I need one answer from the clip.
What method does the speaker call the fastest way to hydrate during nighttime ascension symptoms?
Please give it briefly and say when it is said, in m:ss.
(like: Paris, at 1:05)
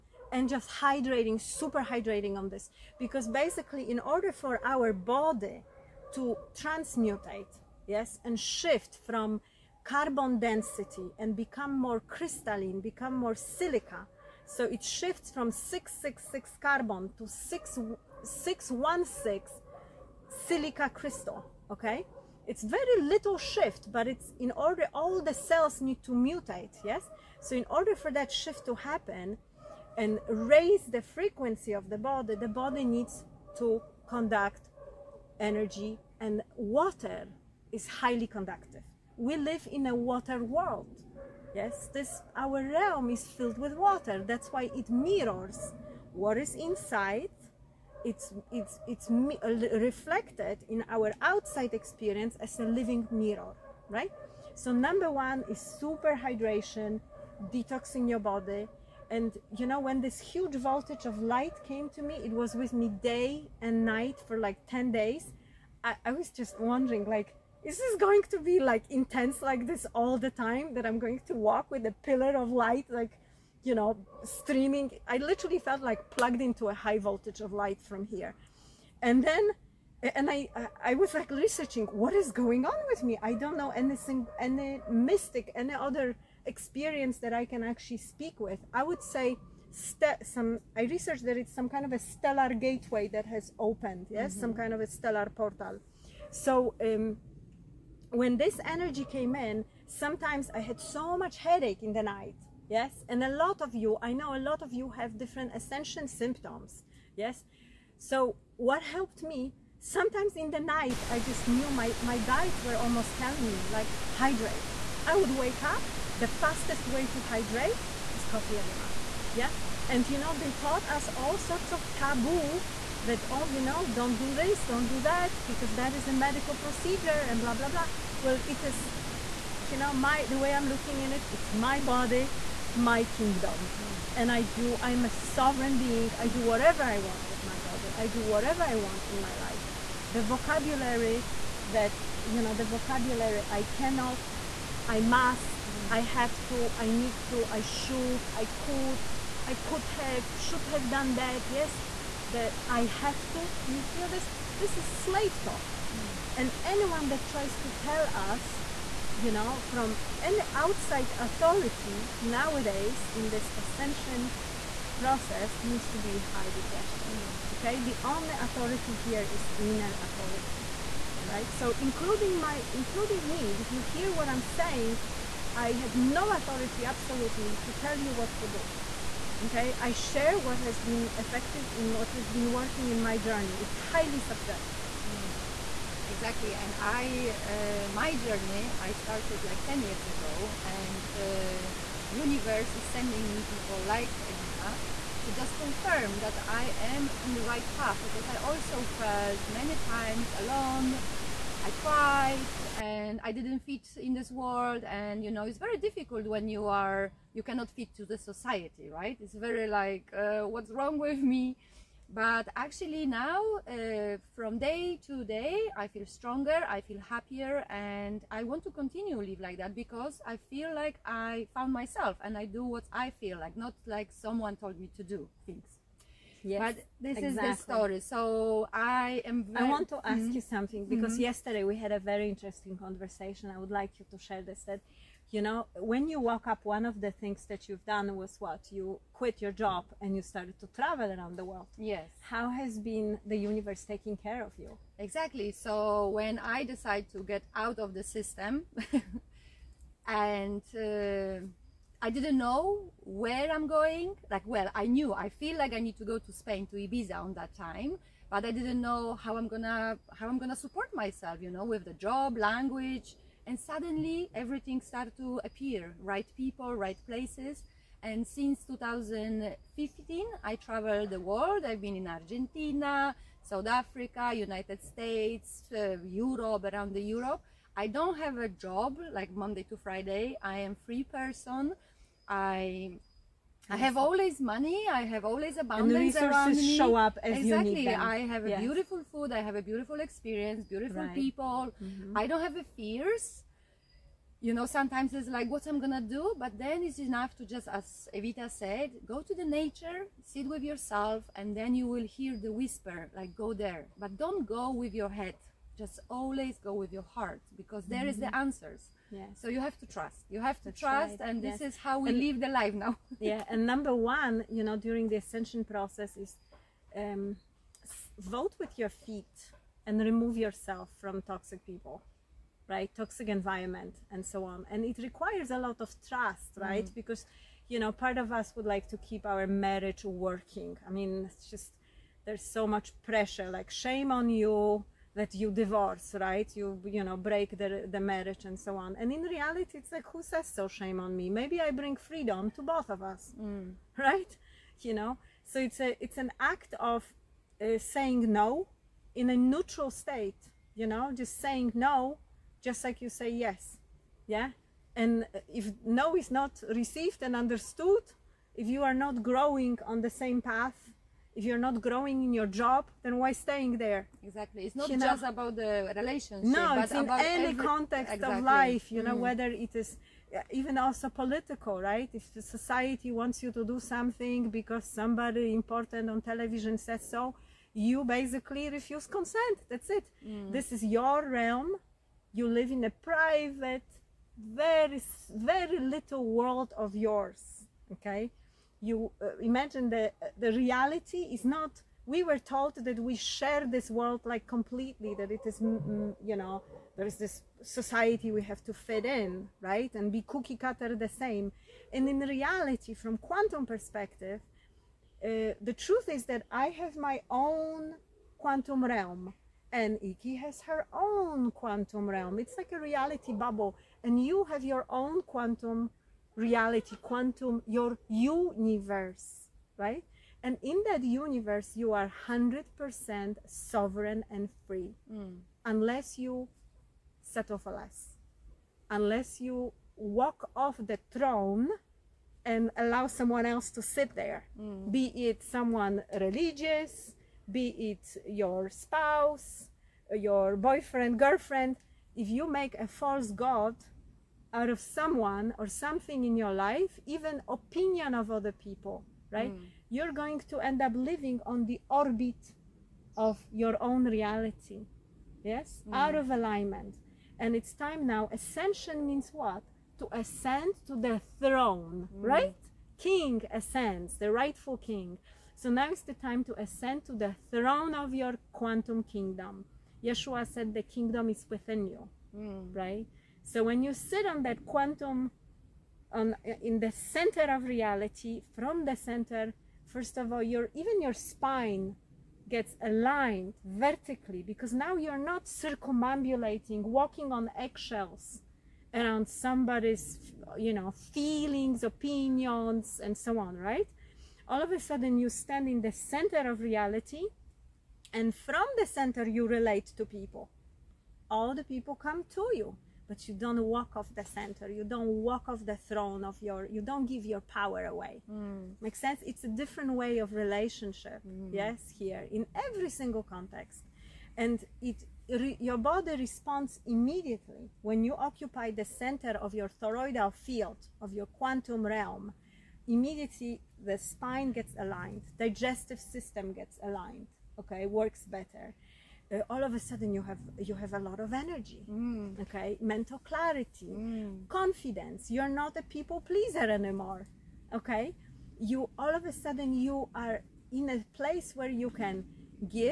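coffee enema, at 1:58.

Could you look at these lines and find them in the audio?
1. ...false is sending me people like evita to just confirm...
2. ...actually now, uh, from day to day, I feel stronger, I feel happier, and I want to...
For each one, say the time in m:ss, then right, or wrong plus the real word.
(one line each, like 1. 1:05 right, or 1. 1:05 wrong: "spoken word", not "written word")
1. 3:12 wrong: "universe", not "false"
2. 3:32 right.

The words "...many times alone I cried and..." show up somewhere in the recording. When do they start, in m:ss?
3:19.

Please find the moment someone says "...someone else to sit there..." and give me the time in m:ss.
7:13.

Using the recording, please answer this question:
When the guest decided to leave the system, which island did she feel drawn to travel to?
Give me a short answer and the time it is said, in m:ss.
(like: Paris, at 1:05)
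Ibiza, at 4:16.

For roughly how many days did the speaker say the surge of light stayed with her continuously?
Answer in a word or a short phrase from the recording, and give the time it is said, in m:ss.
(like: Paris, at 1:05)
10 days, at 1:04.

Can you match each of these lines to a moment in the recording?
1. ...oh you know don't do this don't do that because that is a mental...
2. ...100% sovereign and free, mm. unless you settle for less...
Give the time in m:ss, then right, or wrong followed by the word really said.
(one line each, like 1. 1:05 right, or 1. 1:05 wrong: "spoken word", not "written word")
1. 2:03 wrong: "medical", not "mental"
2. 7:02 right.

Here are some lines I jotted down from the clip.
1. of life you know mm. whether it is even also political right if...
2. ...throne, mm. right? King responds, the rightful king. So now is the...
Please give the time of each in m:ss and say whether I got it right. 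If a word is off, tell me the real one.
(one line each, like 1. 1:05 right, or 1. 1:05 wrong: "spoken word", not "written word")
1. 6:08 right
2. 7:41 wrong: "ascends", not "responds".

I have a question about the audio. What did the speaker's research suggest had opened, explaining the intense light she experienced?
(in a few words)
stellar gateway.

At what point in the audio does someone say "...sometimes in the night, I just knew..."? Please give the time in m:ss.
1:49.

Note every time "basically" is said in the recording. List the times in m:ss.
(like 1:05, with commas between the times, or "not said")
0:03, 6:18.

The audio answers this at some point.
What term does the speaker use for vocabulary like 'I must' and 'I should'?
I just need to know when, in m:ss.
2:34.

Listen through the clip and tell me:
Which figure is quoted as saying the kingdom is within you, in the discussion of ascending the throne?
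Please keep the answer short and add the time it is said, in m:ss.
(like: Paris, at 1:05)
Yeshua, at 7:50.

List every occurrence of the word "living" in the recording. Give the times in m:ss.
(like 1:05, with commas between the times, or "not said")
0:52, 7:31.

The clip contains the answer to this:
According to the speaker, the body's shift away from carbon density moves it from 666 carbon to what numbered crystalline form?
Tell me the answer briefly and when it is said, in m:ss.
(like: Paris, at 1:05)
616 silica crystal, at 0:17.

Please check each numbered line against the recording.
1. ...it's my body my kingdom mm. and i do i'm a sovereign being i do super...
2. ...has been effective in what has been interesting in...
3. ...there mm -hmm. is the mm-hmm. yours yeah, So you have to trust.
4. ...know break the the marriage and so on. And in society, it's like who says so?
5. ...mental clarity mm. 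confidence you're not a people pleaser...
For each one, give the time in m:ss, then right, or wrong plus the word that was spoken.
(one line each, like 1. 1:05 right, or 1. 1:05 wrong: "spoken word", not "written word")
1. 2:11 wrong: "whatever", not "super"
2. 3:00 wrong: "working", not "interesting"
3. 5:07 wrong: "answers", not "yours"
4. 5:37 wrong: "reality", not "society"
5. 8:52 right.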